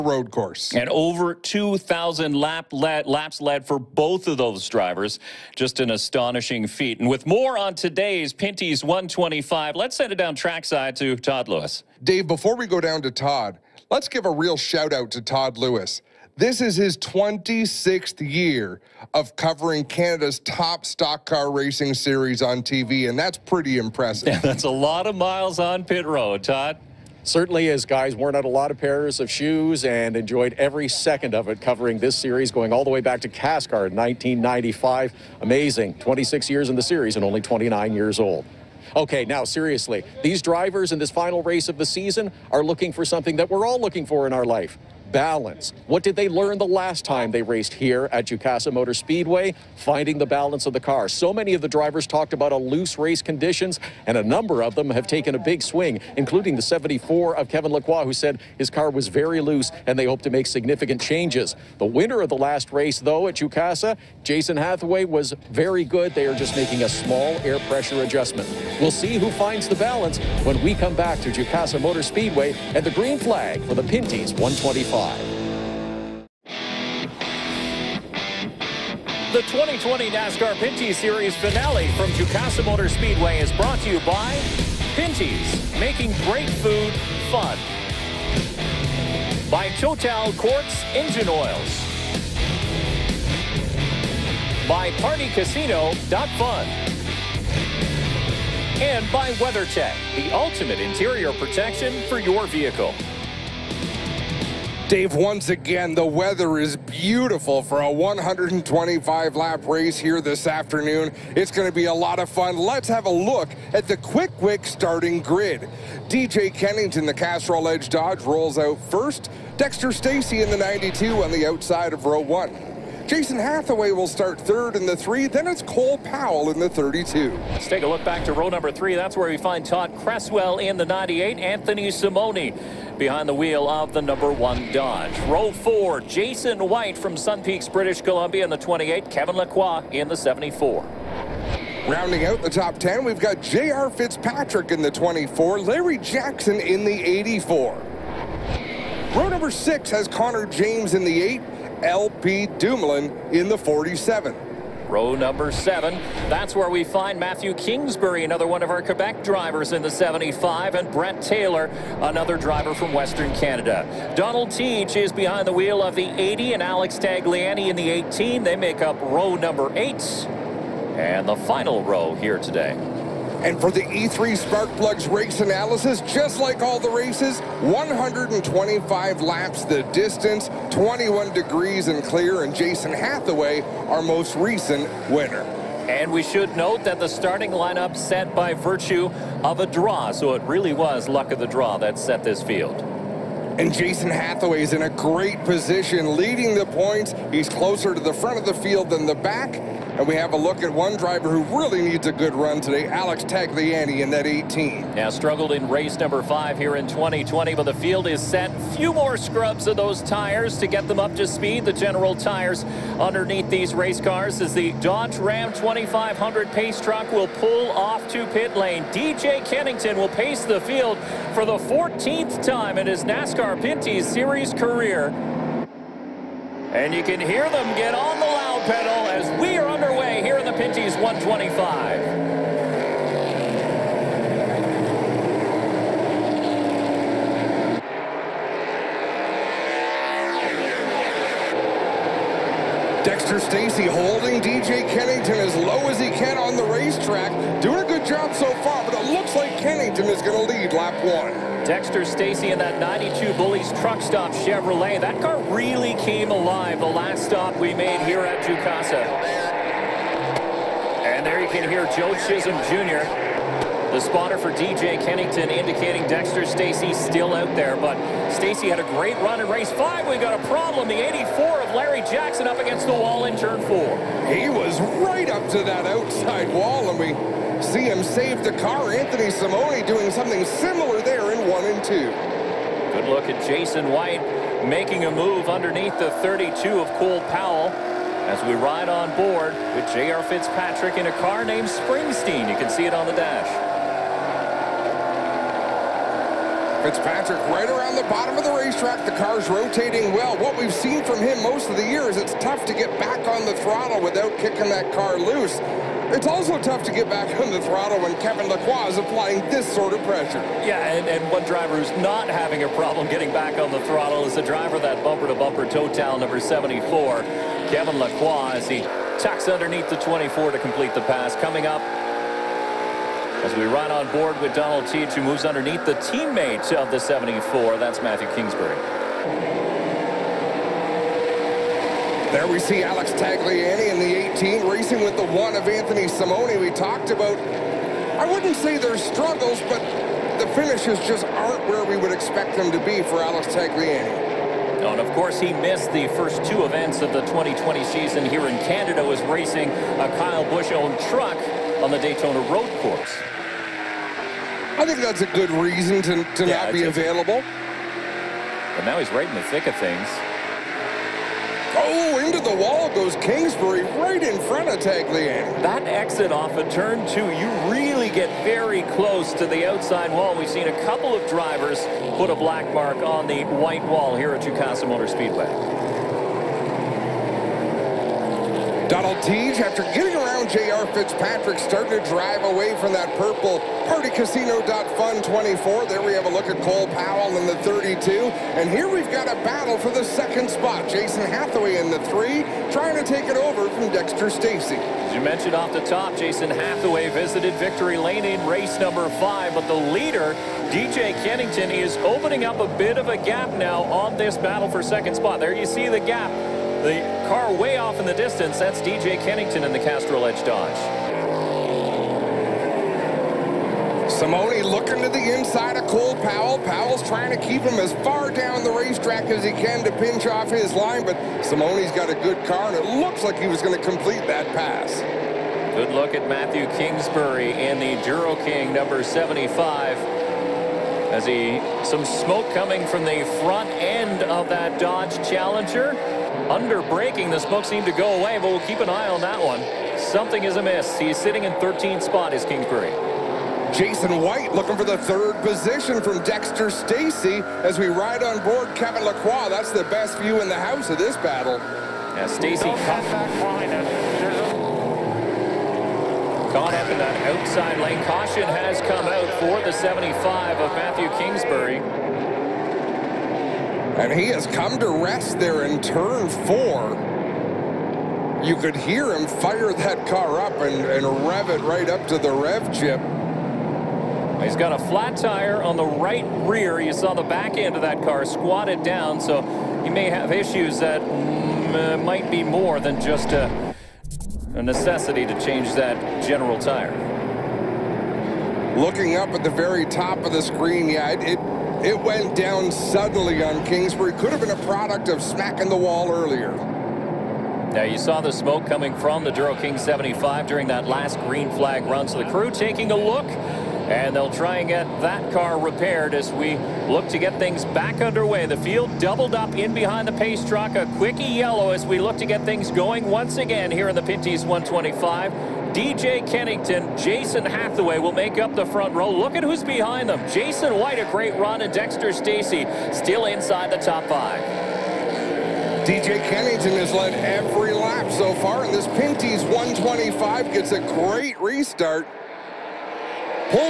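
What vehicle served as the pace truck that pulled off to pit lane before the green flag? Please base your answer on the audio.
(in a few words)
Dodge Ram 2500.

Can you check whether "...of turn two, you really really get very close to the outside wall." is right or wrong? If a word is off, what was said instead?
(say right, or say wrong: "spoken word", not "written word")
right.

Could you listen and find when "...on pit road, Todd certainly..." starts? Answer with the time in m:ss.
0:25.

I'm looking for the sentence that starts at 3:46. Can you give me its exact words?
And you can hear them get on the loud pedal as we are Pinty's 125.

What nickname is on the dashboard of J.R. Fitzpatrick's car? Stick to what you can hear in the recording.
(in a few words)
Springsteen.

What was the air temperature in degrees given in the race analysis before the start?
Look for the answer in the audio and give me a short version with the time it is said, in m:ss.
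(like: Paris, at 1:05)
21, at 3:00.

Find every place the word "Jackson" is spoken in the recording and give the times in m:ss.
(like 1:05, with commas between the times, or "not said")
2:25, 4:32.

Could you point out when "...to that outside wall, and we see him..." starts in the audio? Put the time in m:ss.
4:35.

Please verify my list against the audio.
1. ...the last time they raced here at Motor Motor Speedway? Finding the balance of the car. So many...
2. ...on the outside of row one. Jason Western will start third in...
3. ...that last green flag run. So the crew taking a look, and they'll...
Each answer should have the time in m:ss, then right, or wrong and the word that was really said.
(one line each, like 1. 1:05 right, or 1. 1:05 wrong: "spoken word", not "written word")
1. 0:46 wrong: "Jukasa", not "Motor"
2. 2:01 wrong: "Hathaway", not "Western"
3. 8:20 right.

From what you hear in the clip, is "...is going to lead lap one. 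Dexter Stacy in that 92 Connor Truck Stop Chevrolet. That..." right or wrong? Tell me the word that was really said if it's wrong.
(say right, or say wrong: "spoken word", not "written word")
wrong: "Bullies", not "Connor".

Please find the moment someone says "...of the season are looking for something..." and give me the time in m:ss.
0:41.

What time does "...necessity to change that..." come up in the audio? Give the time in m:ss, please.
8:04.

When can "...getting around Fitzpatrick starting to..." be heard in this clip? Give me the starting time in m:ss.
6:19.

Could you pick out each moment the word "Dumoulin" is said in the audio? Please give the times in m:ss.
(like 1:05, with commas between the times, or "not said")
2:32.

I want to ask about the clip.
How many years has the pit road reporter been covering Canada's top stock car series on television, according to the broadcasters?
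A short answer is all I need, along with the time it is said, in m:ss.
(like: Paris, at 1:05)
26, at 0:16.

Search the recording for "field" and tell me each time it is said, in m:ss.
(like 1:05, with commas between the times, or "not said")
3:12, 3:18, 3:27, 3:40, 8:28.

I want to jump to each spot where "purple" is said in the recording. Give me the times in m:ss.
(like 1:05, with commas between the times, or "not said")
6:23.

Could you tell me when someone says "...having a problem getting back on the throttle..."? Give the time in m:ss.
5:12.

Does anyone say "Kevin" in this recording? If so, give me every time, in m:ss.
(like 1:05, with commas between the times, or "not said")
0:57, 2:19, 5:08, 5:17, 7:28.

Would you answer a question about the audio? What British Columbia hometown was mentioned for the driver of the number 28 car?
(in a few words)
Sun Peaks.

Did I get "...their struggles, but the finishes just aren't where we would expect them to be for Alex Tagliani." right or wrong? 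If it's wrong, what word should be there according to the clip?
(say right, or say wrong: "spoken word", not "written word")
right.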